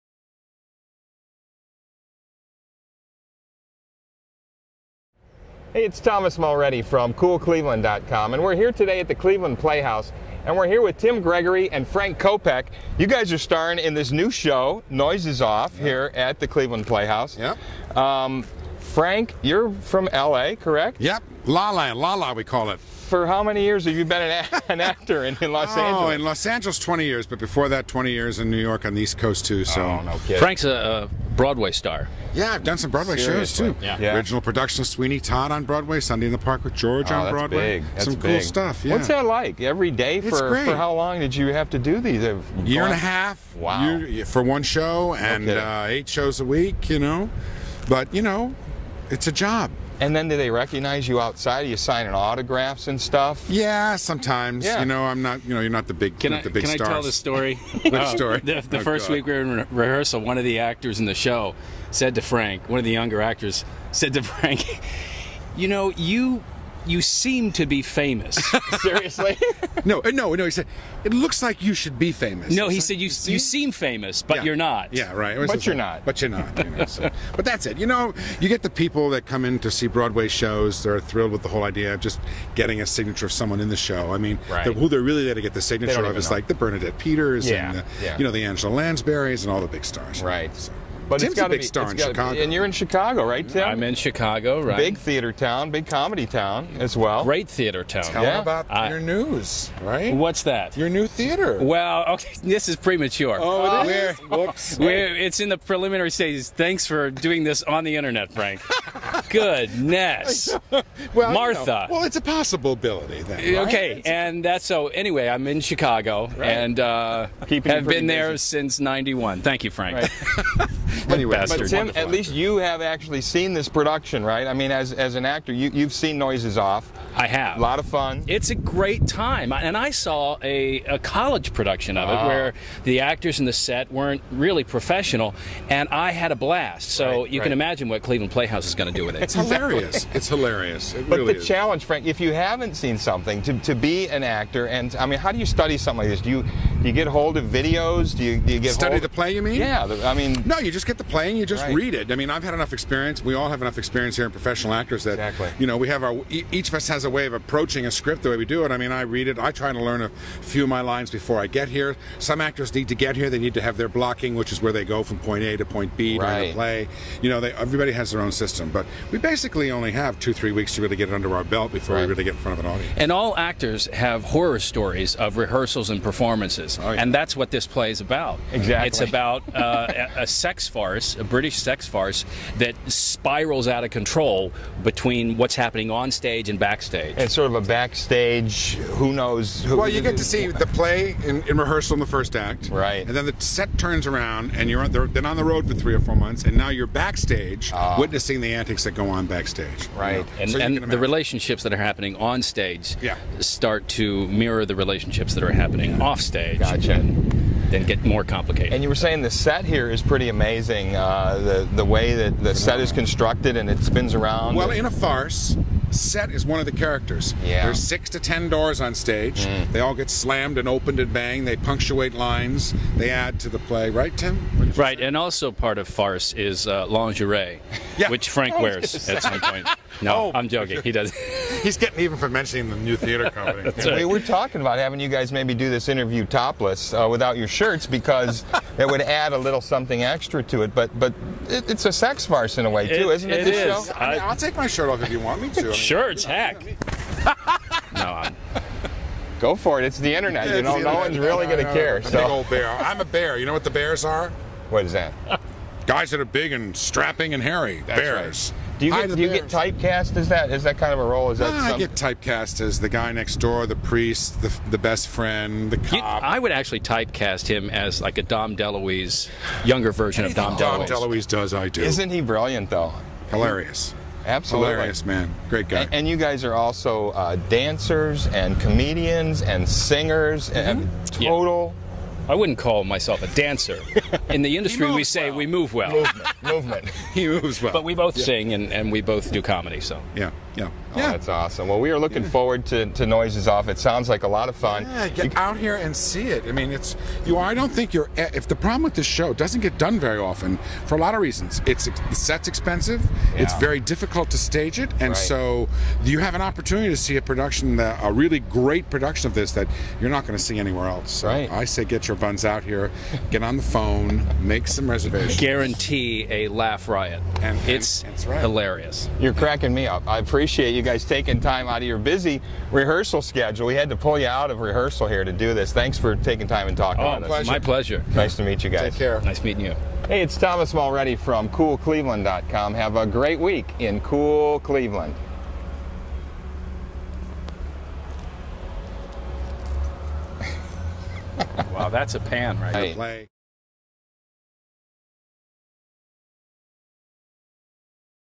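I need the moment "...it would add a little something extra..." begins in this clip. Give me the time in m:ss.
3:58.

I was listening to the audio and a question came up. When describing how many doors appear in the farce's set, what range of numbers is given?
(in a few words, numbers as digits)
6 to 10.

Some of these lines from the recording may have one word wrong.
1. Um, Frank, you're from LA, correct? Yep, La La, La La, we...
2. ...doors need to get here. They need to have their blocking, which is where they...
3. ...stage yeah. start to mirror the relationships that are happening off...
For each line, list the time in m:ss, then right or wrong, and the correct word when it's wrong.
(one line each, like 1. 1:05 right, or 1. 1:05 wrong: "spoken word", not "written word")
1. 0:17 right
2. 2:42 wrong: "actors", not "doors"
3. 3:22 right.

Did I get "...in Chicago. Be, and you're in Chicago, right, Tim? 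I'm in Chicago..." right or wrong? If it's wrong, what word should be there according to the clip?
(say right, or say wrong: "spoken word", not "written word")
right.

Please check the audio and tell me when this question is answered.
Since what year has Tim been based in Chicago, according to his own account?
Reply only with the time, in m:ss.
1:58.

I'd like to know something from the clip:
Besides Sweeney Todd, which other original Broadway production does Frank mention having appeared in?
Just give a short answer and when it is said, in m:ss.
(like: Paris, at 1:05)
Sunday in the Park with George, at 0:35.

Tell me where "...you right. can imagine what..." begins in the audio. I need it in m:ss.
2:17.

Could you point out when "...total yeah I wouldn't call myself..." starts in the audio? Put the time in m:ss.
4:41.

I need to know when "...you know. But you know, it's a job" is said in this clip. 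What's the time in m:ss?
0:46.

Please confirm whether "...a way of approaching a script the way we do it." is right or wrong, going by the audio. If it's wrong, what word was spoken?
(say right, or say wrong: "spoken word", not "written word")
right.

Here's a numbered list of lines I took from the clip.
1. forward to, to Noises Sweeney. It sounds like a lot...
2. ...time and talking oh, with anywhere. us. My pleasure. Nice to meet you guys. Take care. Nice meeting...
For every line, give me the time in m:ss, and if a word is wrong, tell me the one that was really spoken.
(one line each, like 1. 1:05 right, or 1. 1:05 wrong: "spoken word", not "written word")
1. 4:52 wrong: "Off", not "Sweeney"
2. 5:26 wrong: "pleasure", not "anywhere".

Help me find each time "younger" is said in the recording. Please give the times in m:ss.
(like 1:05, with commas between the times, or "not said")
1:02, 4:29.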